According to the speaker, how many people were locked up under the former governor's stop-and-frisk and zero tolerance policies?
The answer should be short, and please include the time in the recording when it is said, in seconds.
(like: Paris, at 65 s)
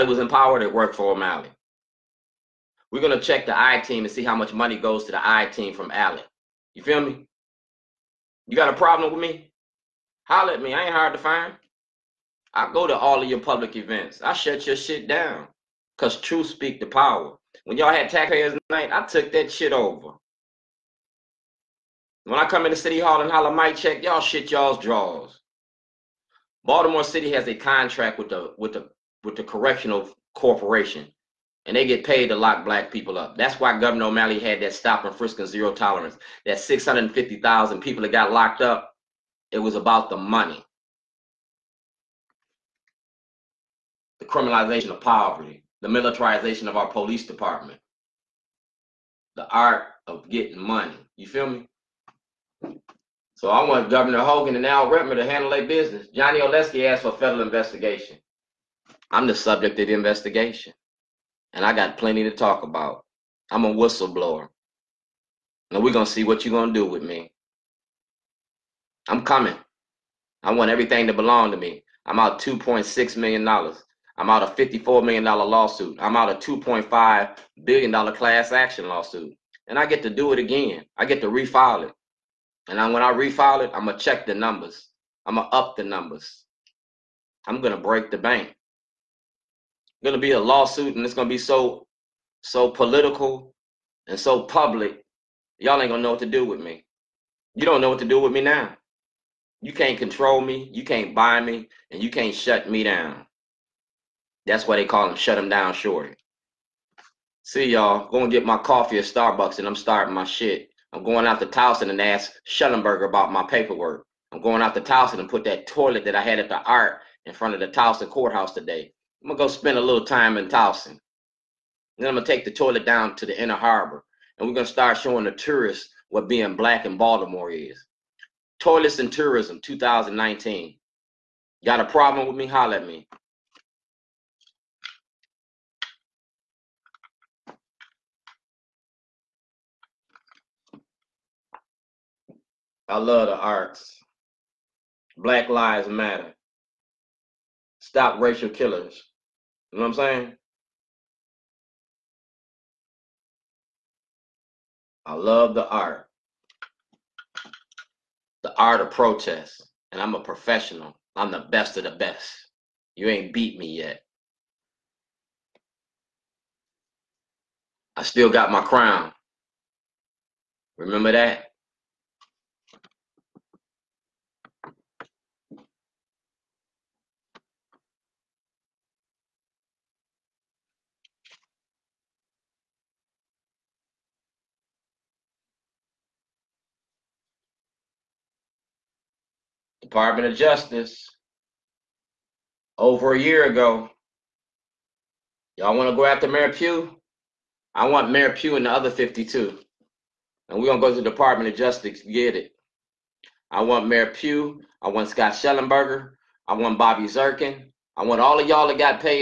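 650,000, at 36 s.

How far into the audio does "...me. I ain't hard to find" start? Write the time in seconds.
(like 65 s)
10 s.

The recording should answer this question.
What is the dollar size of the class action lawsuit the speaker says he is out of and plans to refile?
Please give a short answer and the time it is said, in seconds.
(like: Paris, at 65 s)
$2.5 billion, at 76 s.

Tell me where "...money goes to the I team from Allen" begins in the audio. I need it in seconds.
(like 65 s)
4 s.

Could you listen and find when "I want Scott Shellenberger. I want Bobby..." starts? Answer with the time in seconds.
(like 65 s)
204 s.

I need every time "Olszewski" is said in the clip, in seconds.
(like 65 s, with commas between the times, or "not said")
56 s.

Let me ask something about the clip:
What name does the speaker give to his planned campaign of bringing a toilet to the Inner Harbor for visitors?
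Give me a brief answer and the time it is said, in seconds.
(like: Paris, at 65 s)
Toilets and Tourism 2019, at 128 s.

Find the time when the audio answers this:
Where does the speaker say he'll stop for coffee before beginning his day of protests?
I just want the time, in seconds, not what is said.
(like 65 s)
109 s.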